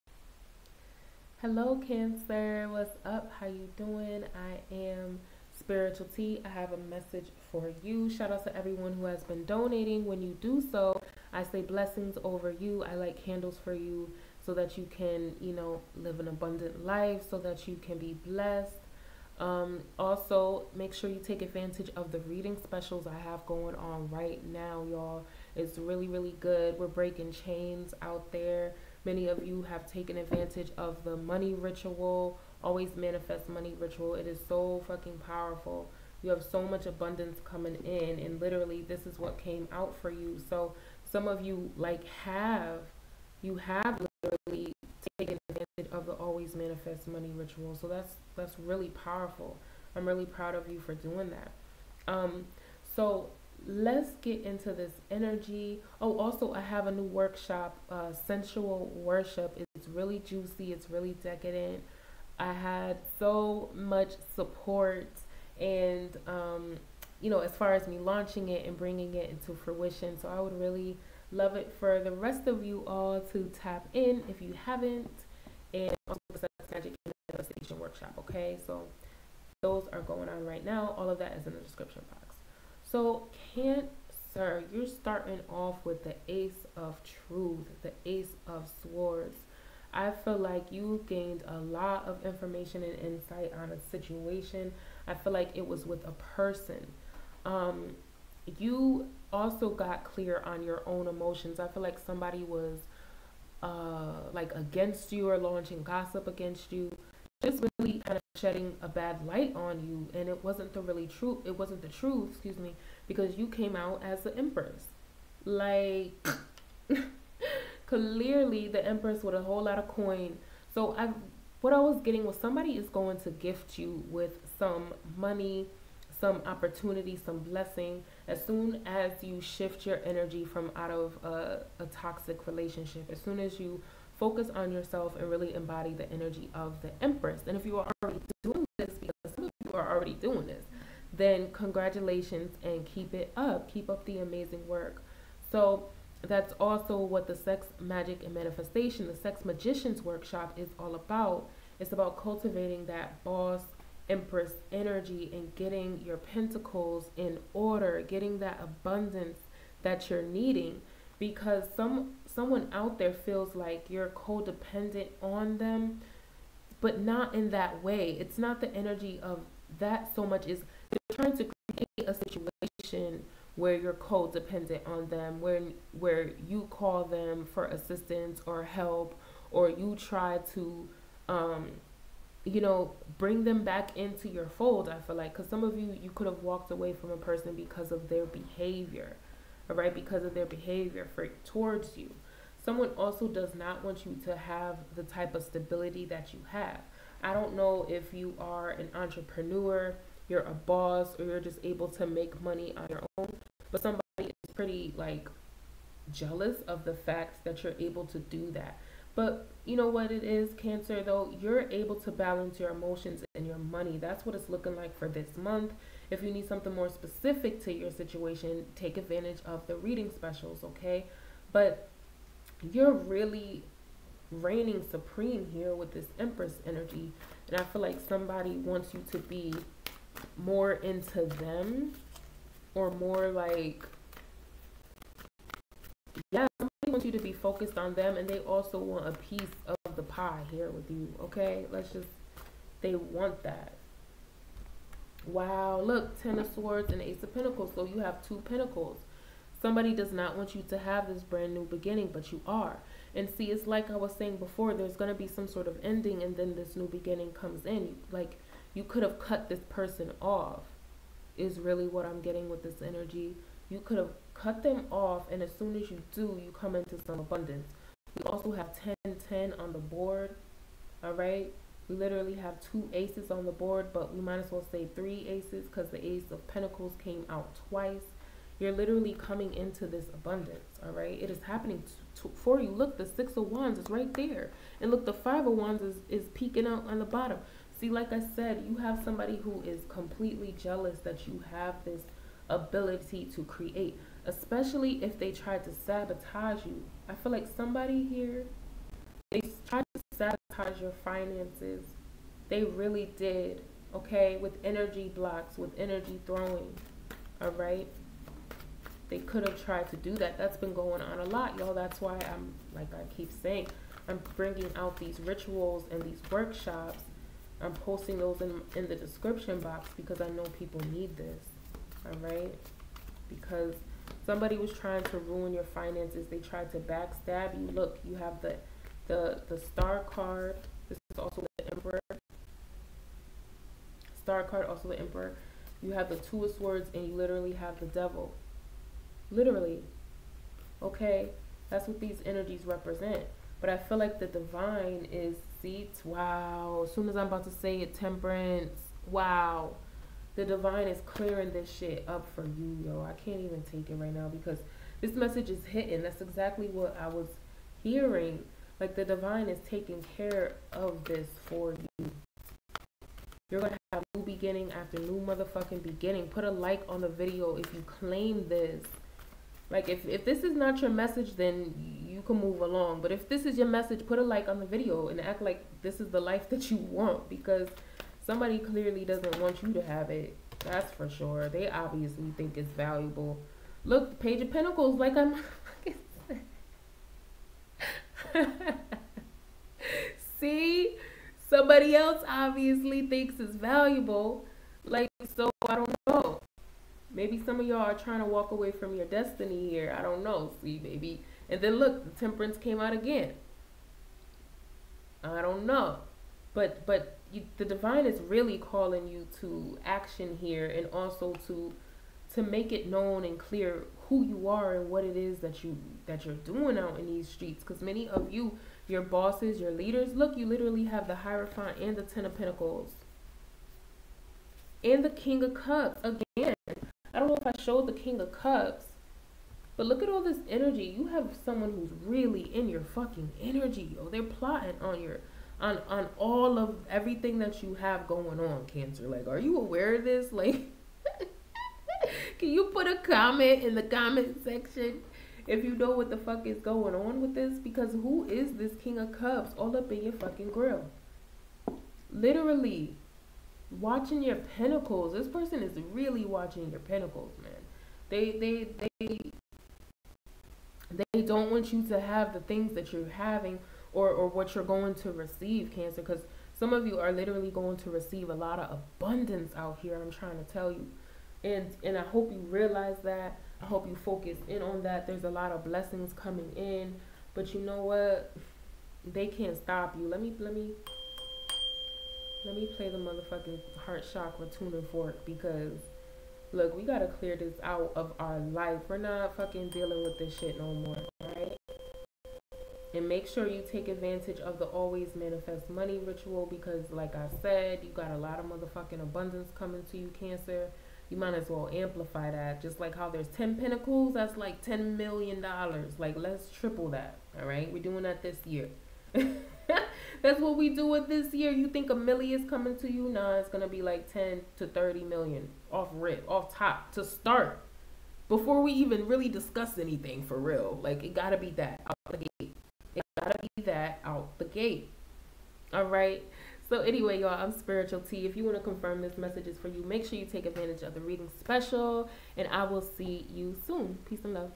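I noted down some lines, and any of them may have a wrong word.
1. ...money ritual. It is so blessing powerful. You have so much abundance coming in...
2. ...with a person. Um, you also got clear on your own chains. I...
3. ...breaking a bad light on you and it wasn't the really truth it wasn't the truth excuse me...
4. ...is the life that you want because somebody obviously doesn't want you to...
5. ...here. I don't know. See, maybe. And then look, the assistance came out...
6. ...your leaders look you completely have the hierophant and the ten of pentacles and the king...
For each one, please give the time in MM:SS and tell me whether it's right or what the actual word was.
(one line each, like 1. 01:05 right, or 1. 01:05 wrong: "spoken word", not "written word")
1. 00:33 wrong: "fucking", not "blessing"
2. 01:35 wrong: "emotions", not "chains"
3. 01:48 wrong: "shedding", not "breaking"
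4. 06:16 wrong: "clearly", not "obviously"
5. 06:39 wrong: "temperance", not "assistance"
6. 06:59 wrong: "literally", not "completely".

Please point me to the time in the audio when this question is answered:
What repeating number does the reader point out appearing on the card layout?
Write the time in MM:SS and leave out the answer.
04:29.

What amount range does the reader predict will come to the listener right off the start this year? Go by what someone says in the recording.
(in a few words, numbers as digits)
10 to 30 million.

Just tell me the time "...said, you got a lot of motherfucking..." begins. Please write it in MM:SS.
08:17.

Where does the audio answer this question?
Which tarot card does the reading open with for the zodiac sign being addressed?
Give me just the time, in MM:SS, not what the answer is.
01:27.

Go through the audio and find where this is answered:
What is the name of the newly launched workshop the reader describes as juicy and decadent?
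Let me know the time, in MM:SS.
00:58.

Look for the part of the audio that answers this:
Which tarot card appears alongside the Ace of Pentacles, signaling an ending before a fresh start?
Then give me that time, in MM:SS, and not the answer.
04:06.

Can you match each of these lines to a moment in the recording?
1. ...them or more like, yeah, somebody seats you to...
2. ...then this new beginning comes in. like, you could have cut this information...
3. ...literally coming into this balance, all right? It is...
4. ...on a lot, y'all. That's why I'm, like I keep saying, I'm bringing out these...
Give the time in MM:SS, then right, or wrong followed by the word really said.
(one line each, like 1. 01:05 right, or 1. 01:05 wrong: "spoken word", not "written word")
1. 03:51 wrong: "wants", not "seats"
2. 04:16 wrong: "person", not "information"
3. 04:38 wrong: "abundance", not "balance"
4. 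05:11 right.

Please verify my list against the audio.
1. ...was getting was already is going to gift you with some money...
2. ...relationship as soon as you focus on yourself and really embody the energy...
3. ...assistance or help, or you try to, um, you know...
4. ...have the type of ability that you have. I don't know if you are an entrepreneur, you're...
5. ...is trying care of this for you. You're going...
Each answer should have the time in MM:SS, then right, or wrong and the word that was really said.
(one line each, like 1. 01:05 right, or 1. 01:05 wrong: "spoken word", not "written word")
1. 02:01 wrong: "somebody", not "already"
2. 02:12 right
3. 02:57 right
4. 03:14 wrong: "stability", not "ability"
5. 05:59 wrong: "taking", not "trying".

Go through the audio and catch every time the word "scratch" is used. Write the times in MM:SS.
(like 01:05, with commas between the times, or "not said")
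not said.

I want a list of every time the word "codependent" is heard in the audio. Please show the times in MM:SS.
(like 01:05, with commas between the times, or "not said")
02:44, 02:53.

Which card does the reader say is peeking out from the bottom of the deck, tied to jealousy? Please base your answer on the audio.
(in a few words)
Five of Wands.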